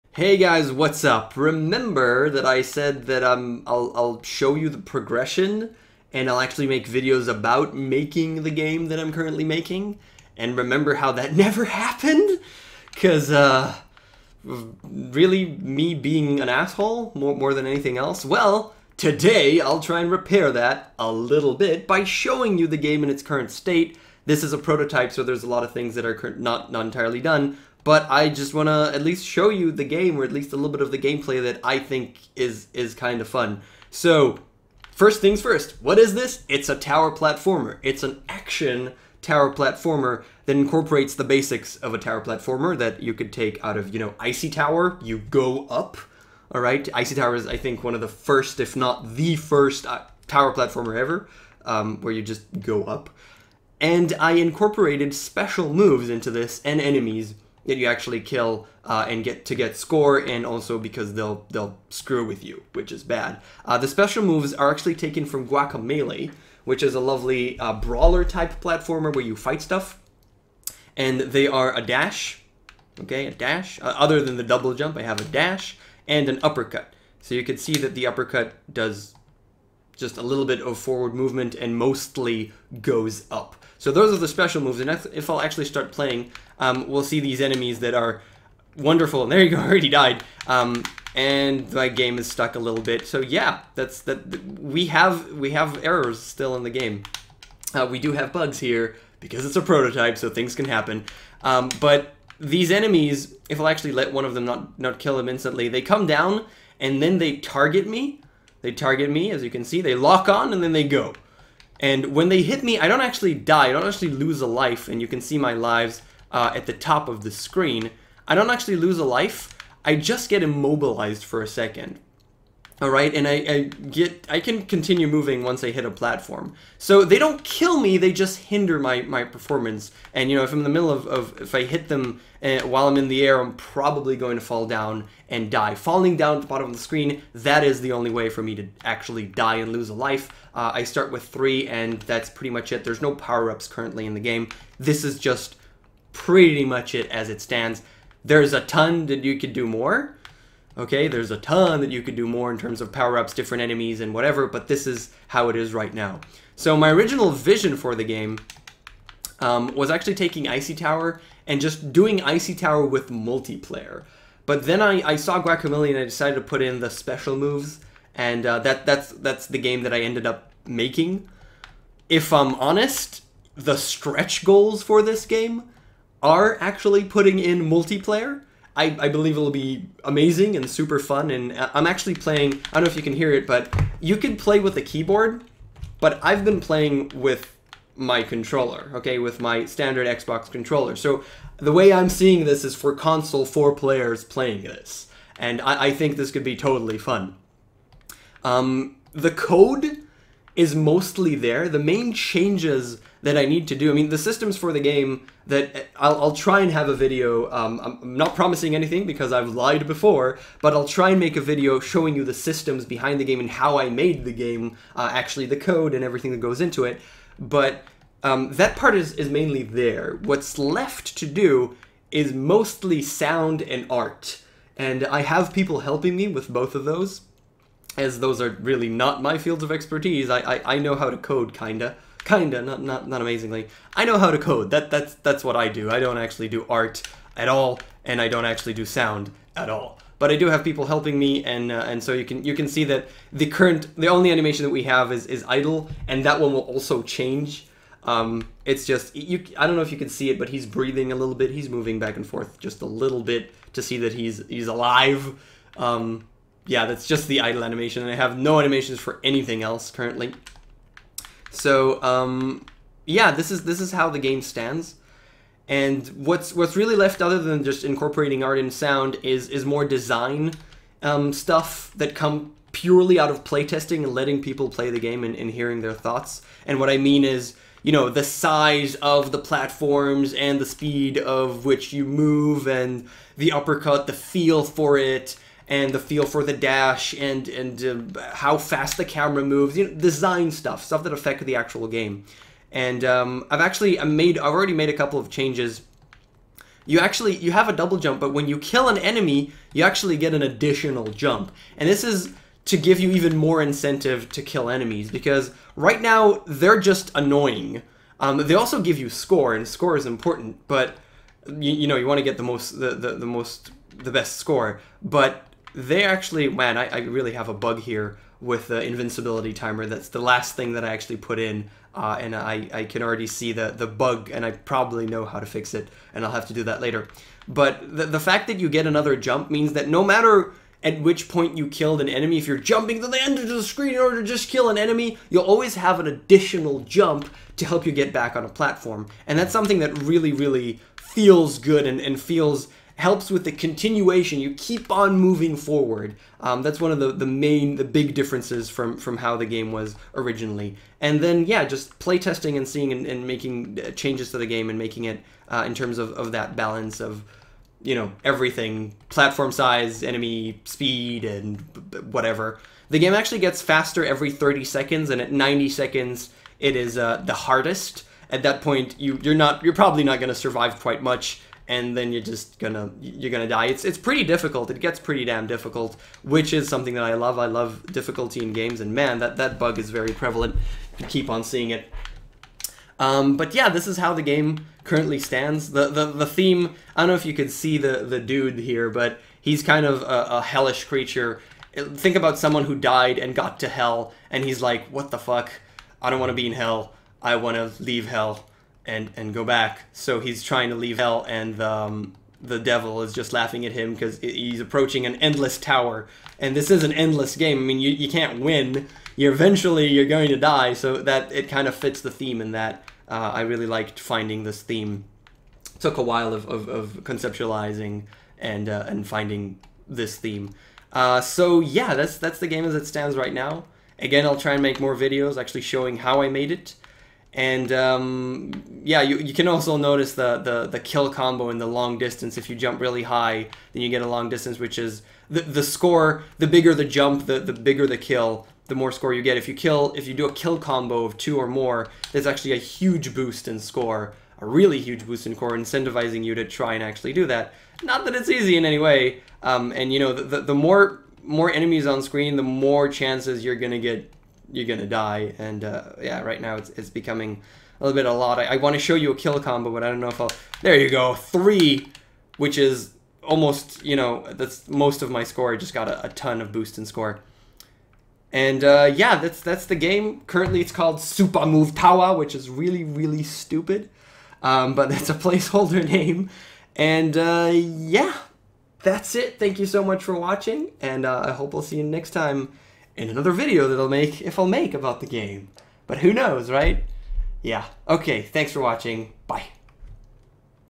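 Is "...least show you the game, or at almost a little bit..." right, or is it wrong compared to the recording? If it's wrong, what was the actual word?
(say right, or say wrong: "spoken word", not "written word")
wrong: "least", not "almost".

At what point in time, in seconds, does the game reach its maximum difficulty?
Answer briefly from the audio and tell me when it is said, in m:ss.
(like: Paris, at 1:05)
90, at 6:05.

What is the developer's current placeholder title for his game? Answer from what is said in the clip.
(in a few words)
SupaMoveTowa.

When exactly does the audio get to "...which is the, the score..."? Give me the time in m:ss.
7:14.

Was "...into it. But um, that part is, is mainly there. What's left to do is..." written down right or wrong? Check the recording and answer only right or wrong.
right.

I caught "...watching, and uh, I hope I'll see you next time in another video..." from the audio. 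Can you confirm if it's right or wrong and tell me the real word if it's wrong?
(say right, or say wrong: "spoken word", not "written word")
right.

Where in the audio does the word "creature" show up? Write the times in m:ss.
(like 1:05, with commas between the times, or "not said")
6:30.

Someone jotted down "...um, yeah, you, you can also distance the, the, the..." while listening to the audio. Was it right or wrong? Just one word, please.
wrong.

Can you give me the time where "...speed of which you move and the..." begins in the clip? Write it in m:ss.
4:40.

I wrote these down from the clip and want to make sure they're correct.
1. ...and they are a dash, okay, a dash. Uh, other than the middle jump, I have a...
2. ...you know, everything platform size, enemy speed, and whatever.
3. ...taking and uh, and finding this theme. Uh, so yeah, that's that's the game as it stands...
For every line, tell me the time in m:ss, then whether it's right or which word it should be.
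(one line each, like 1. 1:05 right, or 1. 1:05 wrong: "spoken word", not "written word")
1. 1:10 wrong: "double", not "middle"
2. 5:57 right
3. 6:57 wrong: "conceptualizing", not "taking".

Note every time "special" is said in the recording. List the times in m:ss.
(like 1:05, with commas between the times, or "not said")
0:55, 1:03, 1:24, 2:46.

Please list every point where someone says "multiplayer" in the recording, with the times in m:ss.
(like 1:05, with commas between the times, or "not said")
2:43, 2:57.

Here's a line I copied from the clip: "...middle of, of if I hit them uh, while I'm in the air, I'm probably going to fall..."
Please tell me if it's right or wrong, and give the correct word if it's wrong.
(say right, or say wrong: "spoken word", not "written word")
right.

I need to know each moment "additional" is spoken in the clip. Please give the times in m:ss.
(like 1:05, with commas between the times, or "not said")
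5:00, 5:36.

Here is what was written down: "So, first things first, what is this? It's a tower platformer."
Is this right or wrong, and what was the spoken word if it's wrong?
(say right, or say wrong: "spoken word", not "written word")
right.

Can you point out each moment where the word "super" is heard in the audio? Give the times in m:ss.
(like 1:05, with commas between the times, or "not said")
3:00.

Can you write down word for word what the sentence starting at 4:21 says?
So um, yeah, this is this is how the game stands.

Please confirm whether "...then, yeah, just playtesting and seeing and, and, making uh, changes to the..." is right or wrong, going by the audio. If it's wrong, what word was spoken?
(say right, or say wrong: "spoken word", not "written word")
right.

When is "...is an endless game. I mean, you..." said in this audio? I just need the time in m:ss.
6:46.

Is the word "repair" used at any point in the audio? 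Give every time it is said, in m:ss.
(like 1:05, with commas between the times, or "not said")
0:20.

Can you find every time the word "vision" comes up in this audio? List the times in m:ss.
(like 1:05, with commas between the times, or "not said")
2:37.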